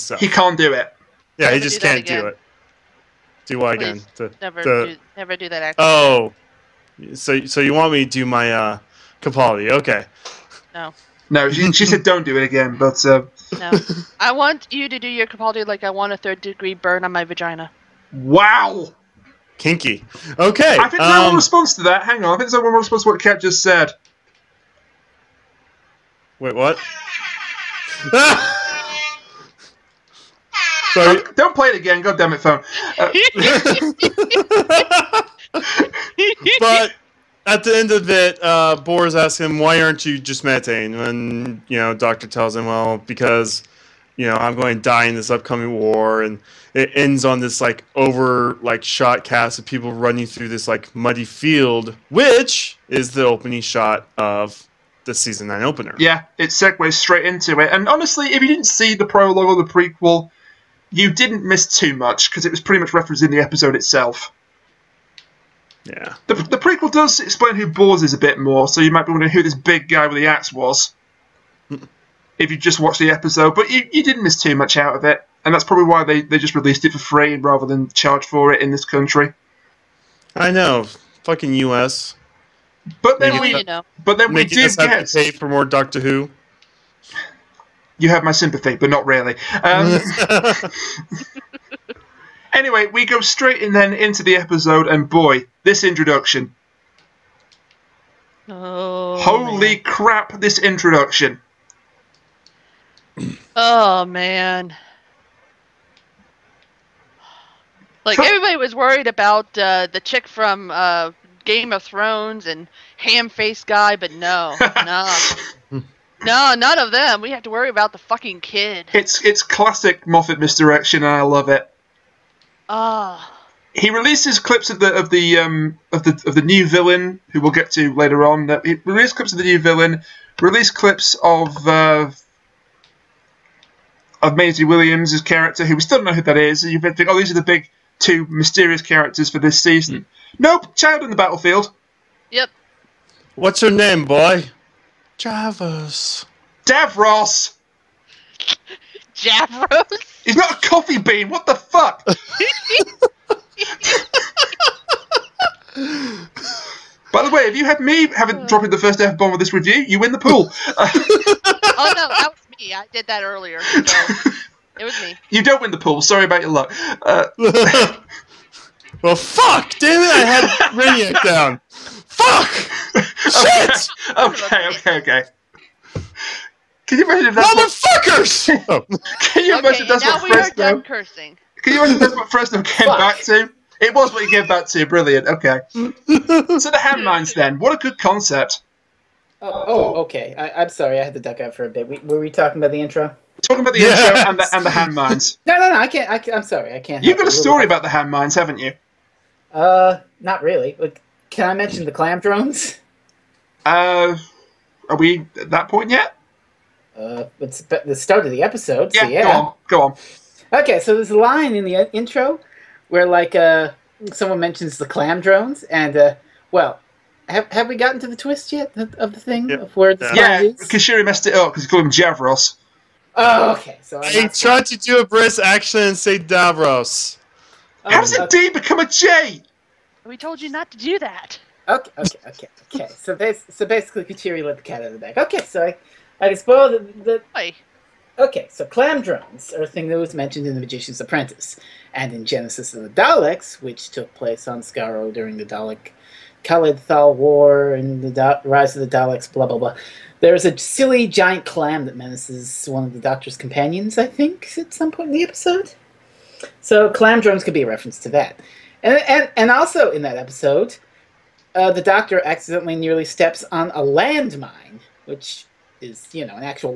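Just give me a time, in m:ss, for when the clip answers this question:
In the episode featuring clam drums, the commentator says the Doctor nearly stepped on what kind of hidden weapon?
4:23.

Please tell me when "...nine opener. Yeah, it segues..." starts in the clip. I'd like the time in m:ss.
0:55.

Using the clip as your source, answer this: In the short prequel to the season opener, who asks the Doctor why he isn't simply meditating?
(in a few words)
Boris.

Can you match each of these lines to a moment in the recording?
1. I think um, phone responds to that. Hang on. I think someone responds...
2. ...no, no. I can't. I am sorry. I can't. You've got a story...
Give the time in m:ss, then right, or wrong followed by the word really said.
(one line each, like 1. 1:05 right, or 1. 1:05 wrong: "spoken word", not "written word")
1. 0:20 wrong: "someone", not "phone"
2. 3:15 right.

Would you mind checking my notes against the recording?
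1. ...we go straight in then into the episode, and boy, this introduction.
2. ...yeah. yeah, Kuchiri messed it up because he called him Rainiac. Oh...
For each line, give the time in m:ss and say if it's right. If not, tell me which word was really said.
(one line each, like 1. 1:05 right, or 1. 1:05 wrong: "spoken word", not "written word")
1. 1:32 right
2. 3:40 wrong: "Javros", not "Rainiac".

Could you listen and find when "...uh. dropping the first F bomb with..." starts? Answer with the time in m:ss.
2:38.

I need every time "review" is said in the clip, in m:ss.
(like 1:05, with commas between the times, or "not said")
2:39.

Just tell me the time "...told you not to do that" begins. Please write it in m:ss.
3:50.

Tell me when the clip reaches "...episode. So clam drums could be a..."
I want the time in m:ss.
4:15.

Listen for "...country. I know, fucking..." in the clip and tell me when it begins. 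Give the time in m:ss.
1:18.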